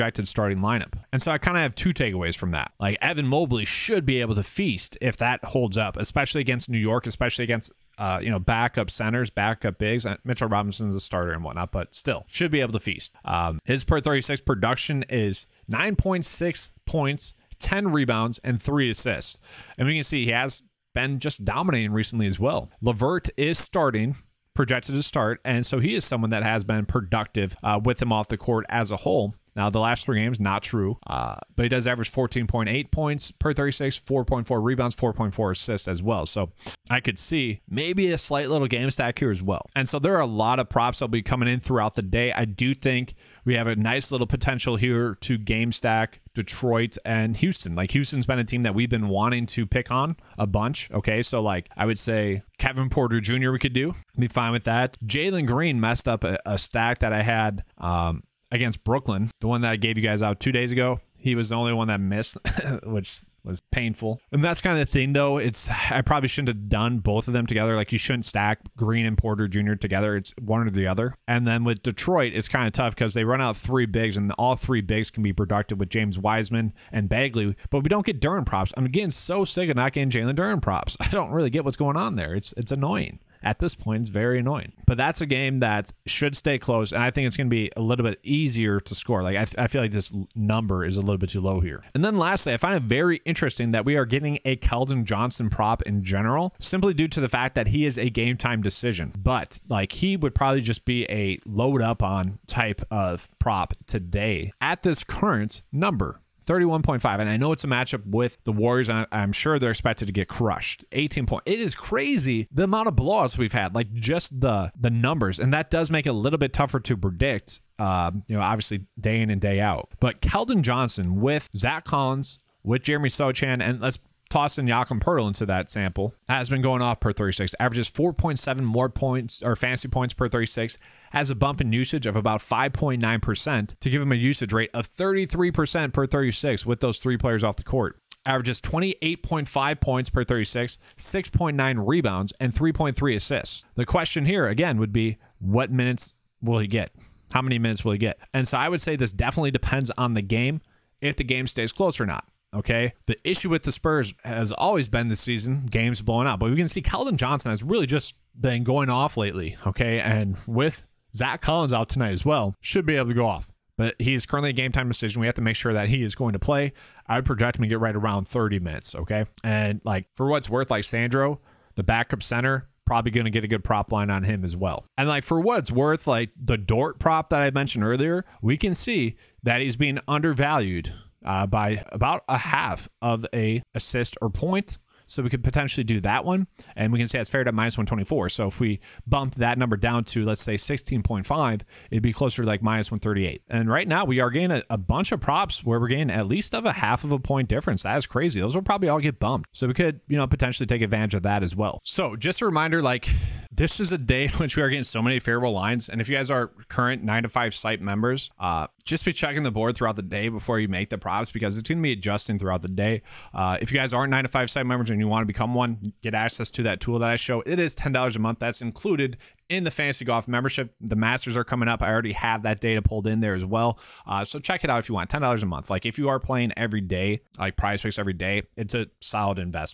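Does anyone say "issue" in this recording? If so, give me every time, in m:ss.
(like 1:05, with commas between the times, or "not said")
2:33.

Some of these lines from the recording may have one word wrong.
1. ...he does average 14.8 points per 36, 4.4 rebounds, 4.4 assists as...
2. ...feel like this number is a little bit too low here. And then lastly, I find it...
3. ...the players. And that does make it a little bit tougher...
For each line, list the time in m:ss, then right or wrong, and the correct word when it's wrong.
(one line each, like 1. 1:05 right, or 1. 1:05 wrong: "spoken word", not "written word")
1. 0:31 right
2. 1:29 right
3. 1:54 wrong: "numbers", not "players".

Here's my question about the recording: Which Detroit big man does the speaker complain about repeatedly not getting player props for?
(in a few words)
Jalen Duren.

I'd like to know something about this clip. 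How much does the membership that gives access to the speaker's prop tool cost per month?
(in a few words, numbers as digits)
$10.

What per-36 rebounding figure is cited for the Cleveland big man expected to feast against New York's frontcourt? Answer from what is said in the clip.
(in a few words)
10.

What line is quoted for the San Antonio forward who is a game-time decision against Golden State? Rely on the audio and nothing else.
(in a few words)
31.5.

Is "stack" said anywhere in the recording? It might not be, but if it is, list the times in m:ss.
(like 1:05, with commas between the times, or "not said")
0:38, 0:45, 0:56, 1:08.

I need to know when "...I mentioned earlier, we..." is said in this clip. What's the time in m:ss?
2:57.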